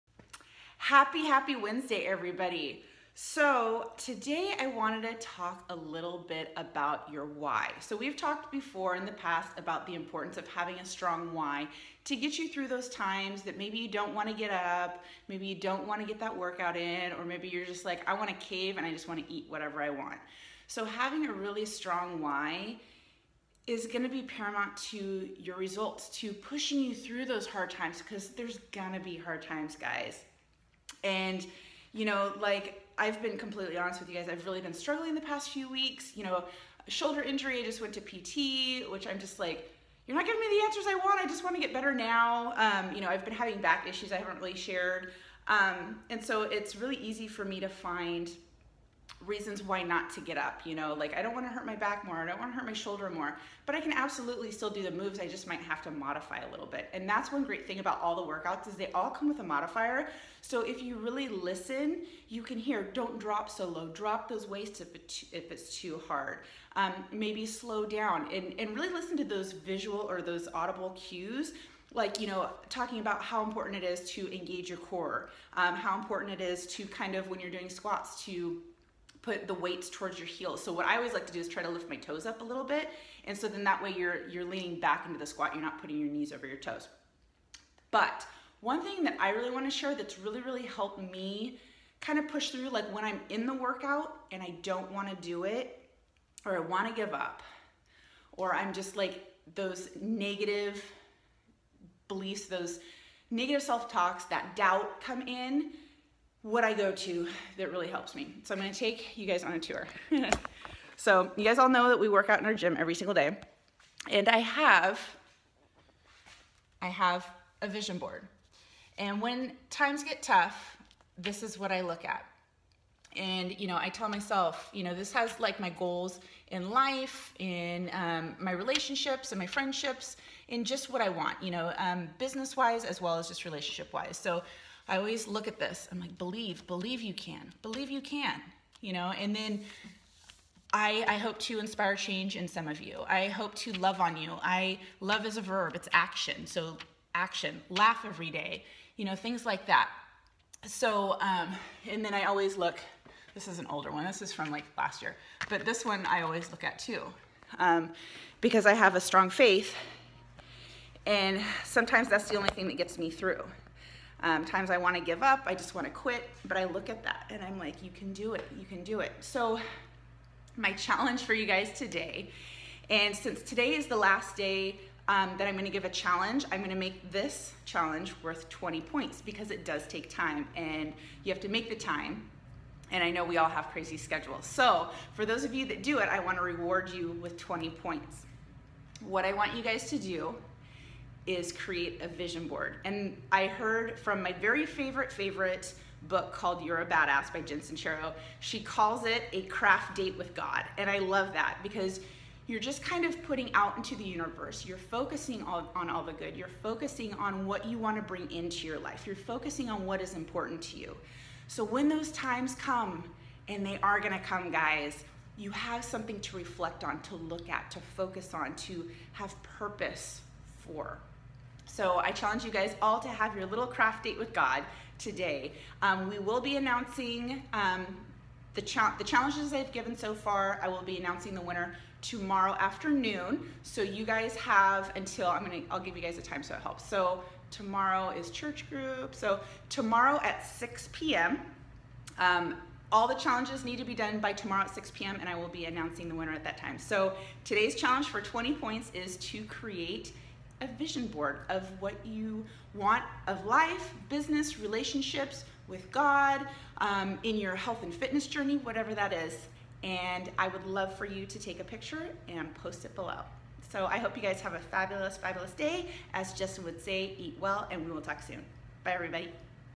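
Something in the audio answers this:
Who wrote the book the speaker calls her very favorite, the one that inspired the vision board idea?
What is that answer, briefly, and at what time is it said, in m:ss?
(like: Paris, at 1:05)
Jen Sincero, at 3:17.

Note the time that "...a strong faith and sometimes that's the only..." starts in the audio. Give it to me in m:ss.
2:38.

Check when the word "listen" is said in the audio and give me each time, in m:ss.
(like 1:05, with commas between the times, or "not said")
1:01, 1:08.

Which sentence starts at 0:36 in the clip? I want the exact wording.
You know, shoulder injury, I just went to PT, which I'm just like, you're not giving me the answers I want.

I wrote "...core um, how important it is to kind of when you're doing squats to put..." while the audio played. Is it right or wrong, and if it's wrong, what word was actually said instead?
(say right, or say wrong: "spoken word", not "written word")
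right.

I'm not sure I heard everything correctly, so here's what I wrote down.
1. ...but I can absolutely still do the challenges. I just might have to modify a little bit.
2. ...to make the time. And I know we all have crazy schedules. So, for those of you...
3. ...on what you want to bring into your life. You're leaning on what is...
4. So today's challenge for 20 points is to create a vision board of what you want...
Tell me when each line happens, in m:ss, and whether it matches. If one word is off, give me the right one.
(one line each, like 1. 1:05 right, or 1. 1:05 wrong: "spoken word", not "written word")
1. 0:53 wrong: "moves", not "challenges"
2. 3:01 right
3. 3:27 wrong: "focusing", not "leaning"
4. 4:06 right.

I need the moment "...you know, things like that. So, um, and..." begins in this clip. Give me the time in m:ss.
2:28.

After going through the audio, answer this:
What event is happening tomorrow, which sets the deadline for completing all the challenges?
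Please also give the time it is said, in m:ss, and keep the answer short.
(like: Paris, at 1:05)
church group, at 3:58.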